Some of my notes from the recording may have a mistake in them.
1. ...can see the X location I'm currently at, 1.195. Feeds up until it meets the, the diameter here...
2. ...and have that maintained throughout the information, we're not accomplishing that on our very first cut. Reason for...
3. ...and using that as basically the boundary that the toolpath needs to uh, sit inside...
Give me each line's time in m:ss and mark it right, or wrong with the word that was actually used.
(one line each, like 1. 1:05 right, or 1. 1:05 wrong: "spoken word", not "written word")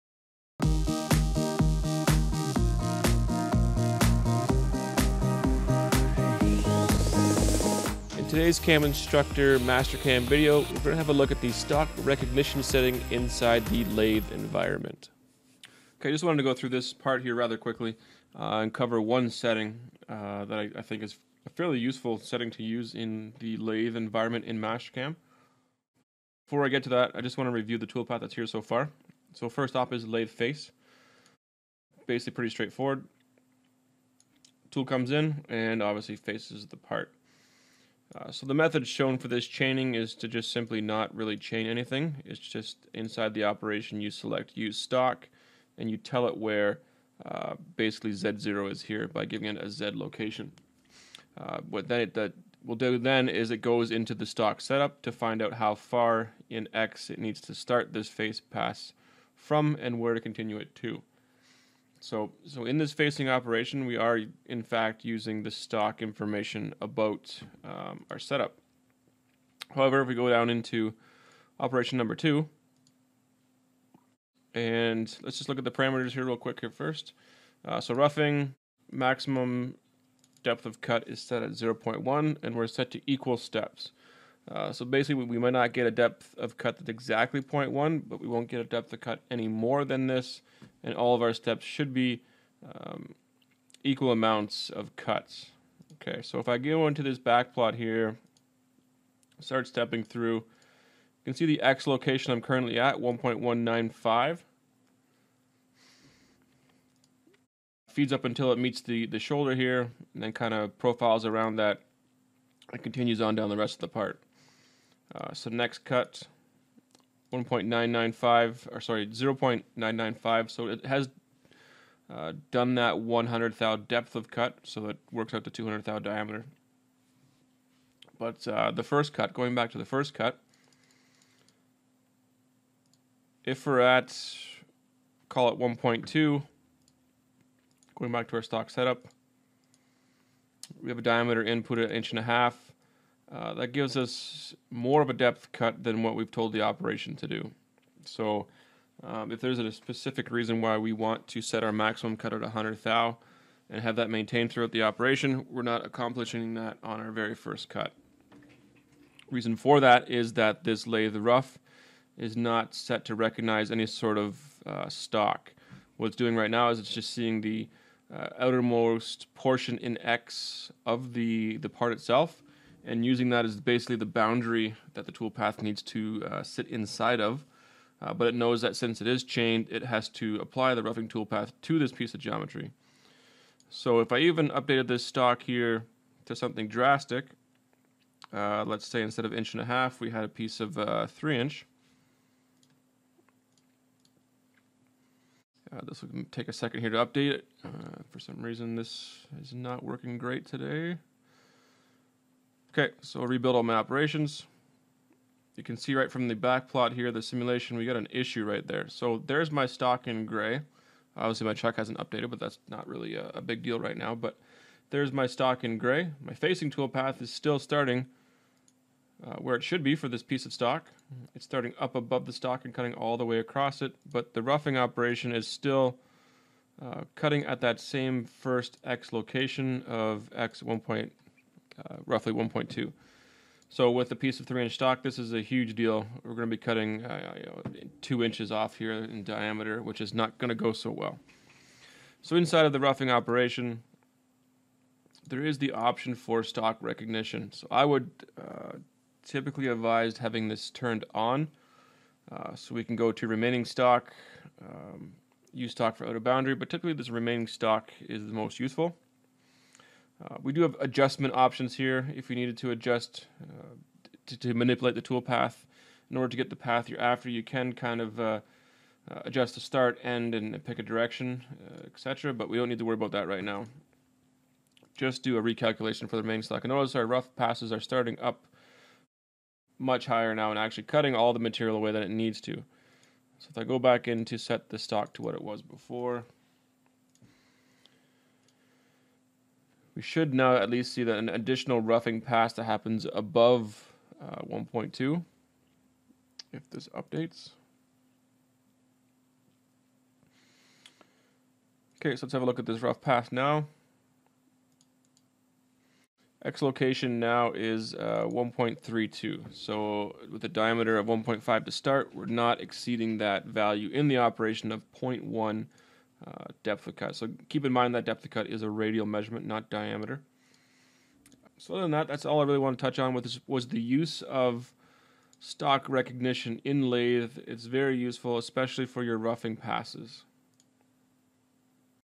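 1. 1:41 wrong: "shoulder", not "diameter"
2. 2:33 wrong: "operation", not "information"
3. 2:52 right.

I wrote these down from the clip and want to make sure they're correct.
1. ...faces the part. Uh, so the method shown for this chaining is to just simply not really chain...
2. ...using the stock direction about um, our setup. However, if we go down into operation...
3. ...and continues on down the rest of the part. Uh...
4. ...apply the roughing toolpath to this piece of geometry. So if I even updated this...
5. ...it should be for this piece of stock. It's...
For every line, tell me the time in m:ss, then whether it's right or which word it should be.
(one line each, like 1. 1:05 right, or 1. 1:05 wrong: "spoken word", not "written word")
1. 0:36 right
2. 1:05 wrong: "information", not "direction"
3. 1:52 right
4. 3:00 right
5. 3:39 right.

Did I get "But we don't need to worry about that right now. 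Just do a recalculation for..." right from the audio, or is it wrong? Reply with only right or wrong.
right.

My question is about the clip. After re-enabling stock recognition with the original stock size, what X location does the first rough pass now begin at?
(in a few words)
1.32.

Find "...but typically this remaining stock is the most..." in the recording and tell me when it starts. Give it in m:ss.
4:16.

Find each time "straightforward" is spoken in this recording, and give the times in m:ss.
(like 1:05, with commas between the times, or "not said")
0:32.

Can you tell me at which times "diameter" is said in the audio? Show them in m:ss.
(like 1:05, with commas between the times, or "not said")
2:05, 2:21, 3:59, 5:10, 5:19.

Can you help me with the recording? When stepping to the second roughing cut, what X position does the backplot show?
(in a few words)
0.995.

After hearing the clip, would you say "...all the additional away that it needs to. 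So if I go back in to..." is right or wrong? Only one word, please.
wrong.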